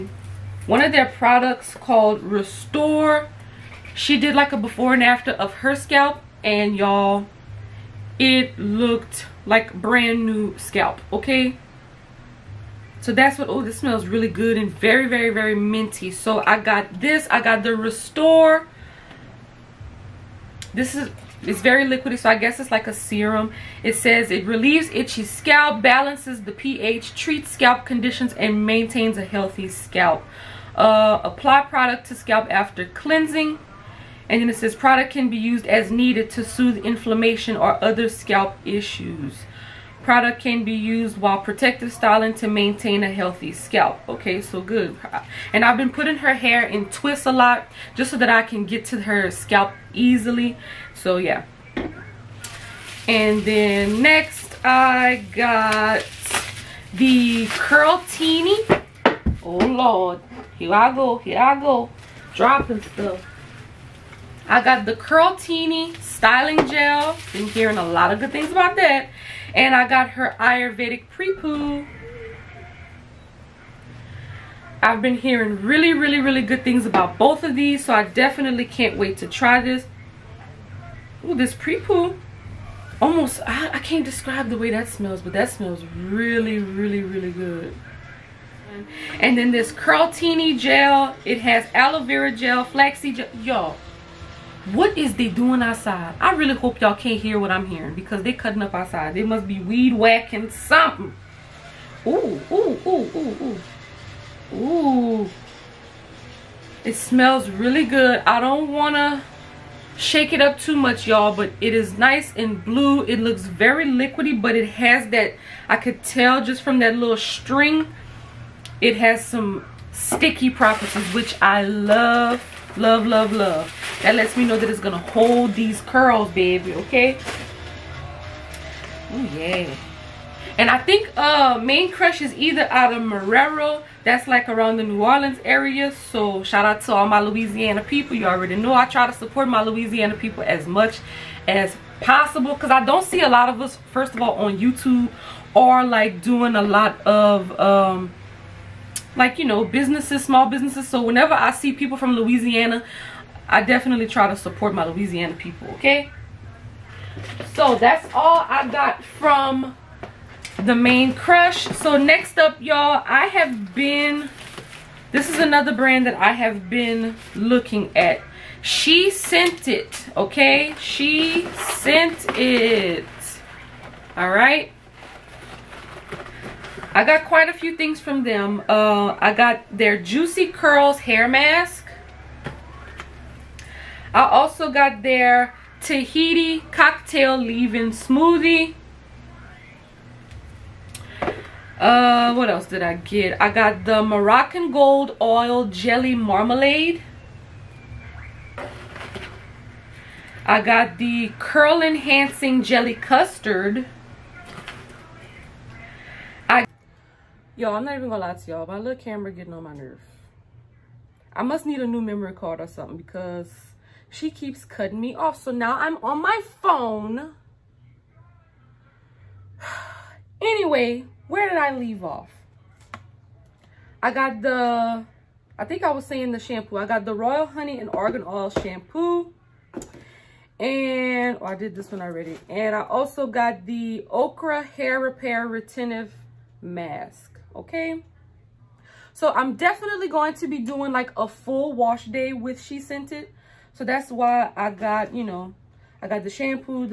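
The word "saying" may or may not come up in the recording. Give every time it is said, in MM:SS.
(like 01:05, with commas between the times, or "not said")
03:46.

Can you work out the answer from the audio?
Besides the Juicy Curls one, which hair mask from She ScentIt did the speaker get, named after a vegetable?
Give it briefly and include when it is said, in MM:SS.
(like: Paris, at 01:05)
Okra Hair Repair Retentive Mask, at 03:54.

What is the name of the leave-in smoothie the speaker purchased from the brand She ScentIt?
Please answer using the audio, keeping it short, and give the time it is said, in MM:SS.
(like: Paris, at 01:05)
Tahiti cocktail, at 03:05.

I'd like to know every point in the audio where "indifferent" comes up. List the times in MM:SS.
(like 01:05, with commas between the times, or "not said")
not said.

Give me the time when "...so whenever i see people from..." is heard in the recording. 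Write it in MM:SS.
02:30.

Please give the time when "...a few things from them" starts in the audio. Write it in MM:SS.
02:57.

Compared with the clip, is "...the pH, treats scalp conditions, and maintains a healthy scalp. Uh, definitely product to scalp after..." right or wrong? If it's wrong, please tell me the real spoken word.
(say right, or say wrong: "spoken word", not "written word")
wrong: "apply", not "definitely".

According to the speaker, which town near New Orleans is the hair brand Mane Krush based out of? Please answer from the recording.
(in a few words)
Marrero.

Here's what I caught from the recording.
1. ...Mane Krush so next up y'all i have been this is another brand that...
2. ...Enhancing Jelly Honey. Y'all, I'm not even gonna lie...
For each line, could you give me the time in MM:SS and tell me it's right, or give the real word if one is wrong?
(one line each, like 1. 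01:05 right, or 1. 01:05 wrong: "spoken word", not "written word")
1. 02:40 right
2. 03:21 wrong: "Custard", not "Honey".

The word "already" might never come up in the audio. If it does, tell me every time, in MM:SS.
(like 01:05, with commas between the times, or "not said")
02:18, 03:52.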